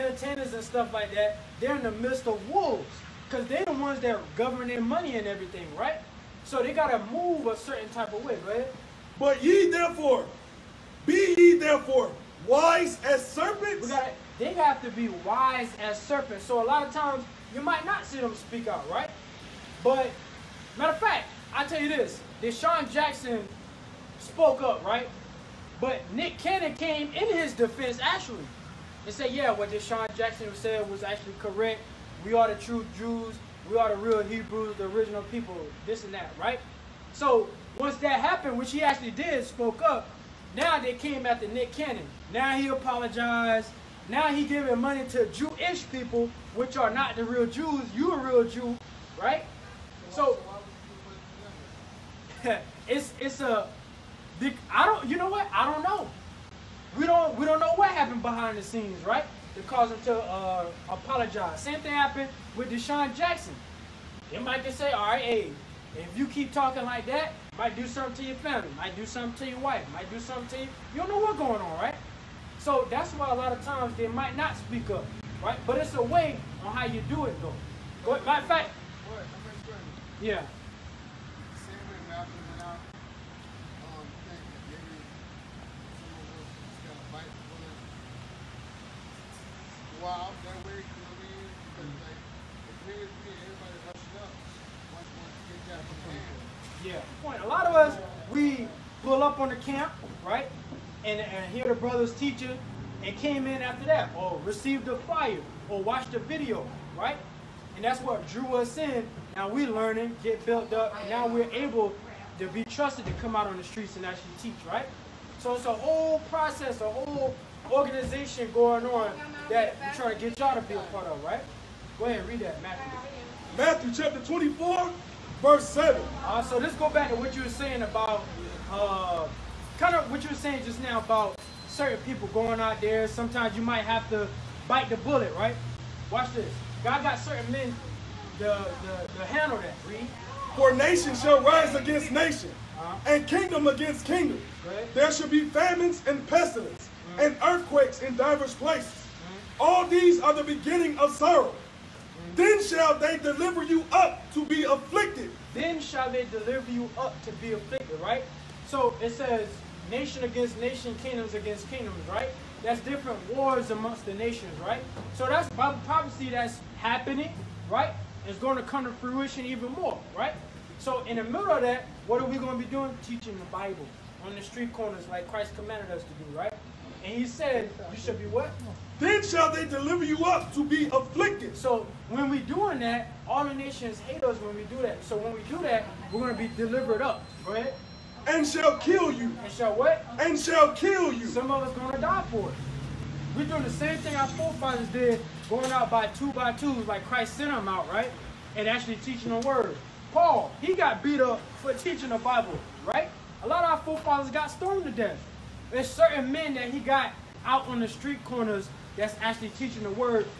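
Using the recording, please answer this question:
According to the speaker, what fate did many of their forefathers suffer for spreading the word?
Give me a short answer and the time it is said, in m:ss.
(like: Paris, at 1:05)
Stoned to death, at 3:24.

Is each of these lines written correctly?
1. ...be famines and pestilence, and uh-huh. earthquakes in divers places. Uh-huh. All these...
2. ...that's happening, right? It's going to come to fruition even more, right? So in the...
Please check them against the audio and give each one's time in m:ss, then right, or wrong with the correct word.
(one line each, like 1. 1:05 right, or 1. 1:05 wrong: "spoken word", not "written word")
1. 2:25 right
2. 2:46 right.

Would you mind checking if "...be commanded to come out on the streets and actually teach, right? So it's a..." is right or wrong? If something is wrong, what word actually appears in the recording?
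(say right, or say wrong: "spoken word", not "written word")
wrong: "trusted", not "commanded".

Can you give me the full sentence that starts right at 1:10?
You don't know what's going on, right?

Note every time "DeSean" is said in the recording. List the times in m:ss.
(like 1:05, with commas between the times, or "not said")
0:22, 0:29, 1:02.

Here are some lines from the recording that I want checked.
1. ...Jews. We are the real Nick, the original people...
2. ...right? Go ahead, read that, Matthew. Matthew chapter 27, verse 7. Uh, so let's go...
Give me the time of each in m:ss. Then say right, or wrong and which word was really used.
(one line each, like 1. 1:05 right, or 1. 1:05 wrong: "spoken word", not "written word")
1. 0:32 wrong: "Hebrews", not "Nick"
2. 2:01 wrong: "24", not "27".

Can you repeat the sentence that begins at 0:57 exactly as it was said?
We don't know what happened behind the scenes, right?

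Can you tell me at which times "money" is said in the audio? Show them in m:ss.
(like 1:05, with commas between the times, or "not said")
0:04, 0:44.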